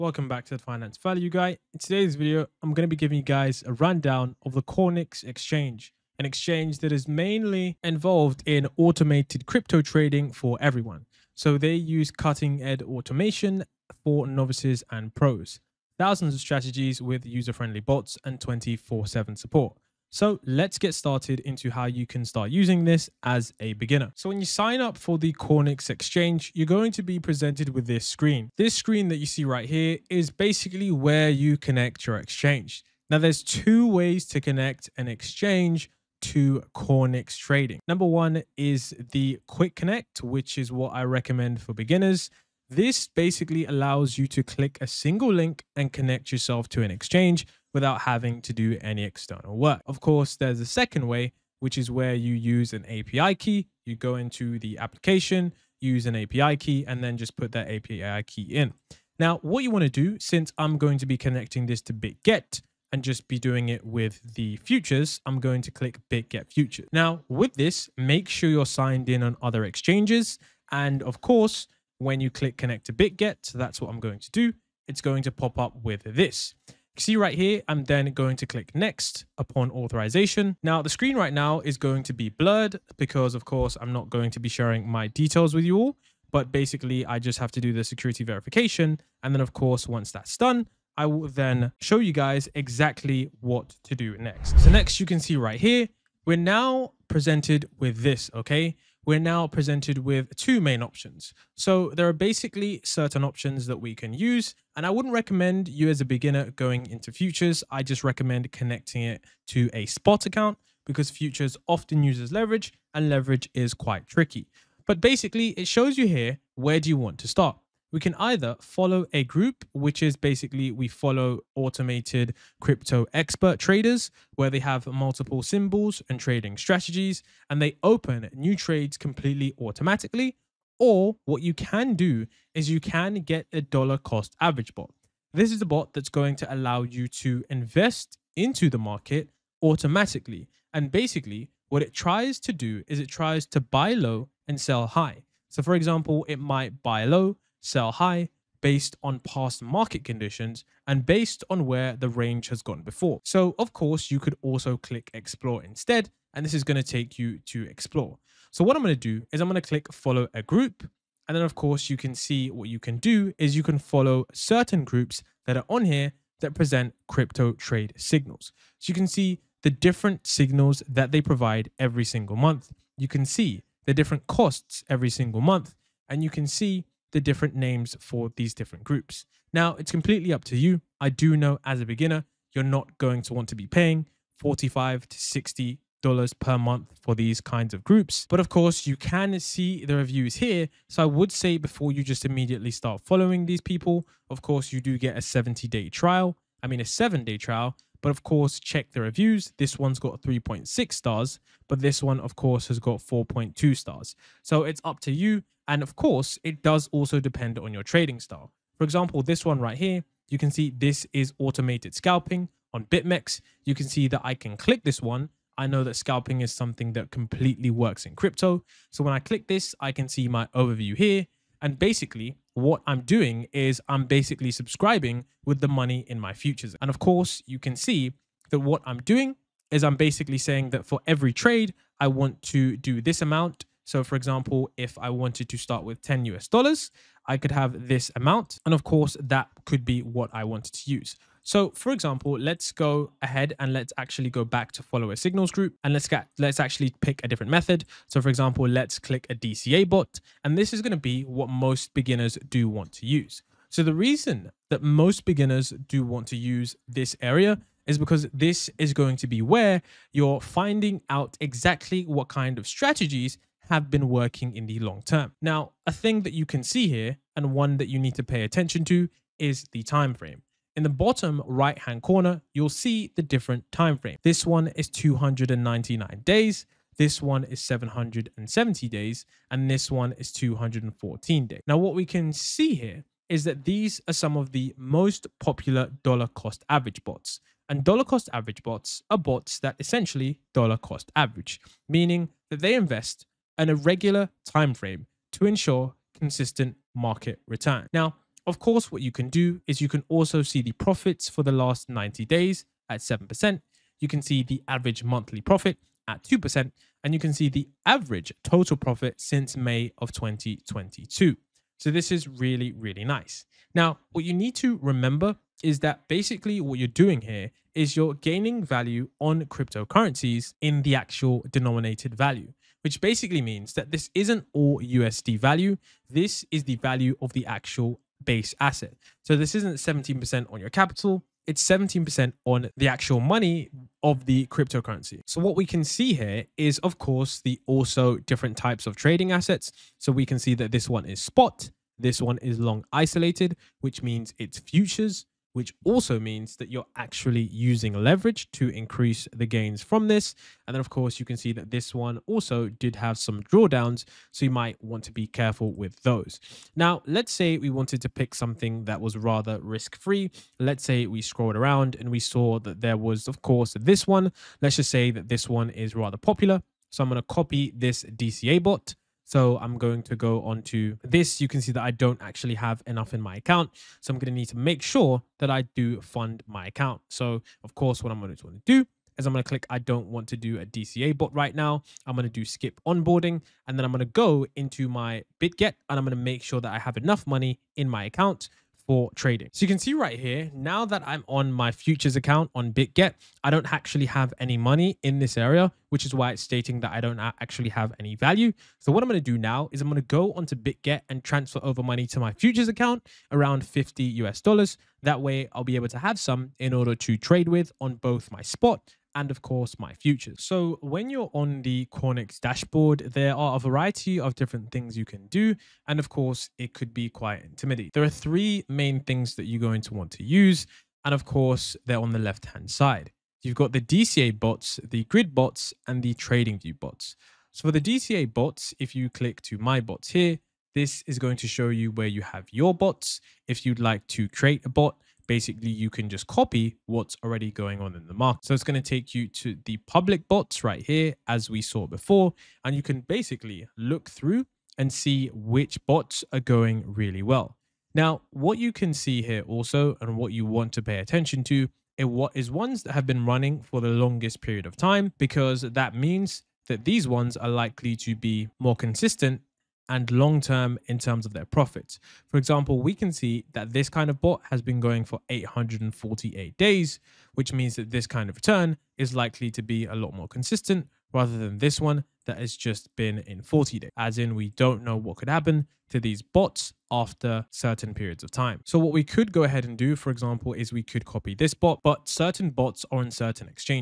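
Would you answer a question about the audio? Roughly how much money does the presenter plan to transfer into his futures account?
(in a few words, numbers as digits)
50 US dollars.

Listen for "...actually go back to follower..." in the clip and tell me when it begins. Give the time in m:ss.
4:03.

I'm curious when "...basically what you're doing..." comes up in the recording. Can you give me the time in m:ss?
5:16.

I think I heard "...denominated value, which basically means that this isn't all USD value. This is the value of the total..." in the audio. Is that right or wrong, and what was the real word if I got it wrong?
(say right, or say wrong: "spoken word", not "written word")
wrong: "actual", not "total".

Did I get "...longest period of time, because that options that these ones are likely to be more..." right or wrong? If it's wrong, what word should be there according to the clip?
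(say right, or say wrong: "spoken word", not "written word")
wrong: "means", not "options".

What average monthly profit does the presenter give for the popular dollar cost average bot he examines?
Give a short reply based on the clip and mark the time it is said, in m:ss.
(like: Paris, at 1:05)
2%, at 5:06.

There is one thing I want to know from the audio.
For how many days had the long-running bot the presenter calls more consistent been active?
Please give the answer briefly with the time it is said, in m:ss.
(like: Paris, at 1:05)
848 days, at 7:45.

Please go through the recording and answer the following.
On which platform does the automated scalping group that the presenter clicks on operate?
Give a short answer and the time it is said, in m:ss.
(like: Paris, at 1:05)
BitMEX, at 3:32.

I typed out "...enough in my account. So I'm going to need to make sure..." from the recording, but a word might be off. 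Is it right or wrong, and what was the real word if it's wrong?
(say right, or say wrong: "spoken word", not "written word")
right.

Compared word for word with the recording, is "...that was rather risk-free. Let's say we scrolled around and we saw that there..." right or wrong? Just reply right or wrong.
right.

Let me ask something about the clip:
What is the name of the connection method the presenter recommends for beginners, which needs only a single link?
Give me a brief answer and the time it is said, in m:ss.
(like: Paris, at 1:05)
Quick connect, at 0:39.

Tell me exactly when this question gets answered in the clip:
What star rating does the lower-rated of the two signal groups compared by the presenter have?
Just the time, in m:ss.
3:20.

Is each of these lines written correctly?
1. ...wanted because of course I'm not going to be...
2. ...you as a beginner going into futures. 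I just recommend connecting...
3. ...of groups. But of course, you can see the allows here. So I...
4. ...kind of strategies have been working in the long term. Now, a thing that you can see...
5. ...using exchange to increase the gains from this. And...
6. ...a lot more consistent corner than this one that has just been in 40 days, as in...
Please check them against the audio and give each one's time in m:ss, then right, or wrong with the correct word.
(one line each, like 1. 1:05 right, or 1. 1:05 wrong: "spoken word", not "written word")
1. 1:22 wrong: "blurred", not "wanted"
2. 1:45 right
3. 3:07 wrong: "reviews", not "allows"
4. 4:22 right
5. 5:47 wrong: "leverage", not "exchange"
6. 7:49 wrong: "rather", not "corner".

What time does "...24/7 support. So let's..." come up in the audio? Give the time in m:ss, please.
0:18.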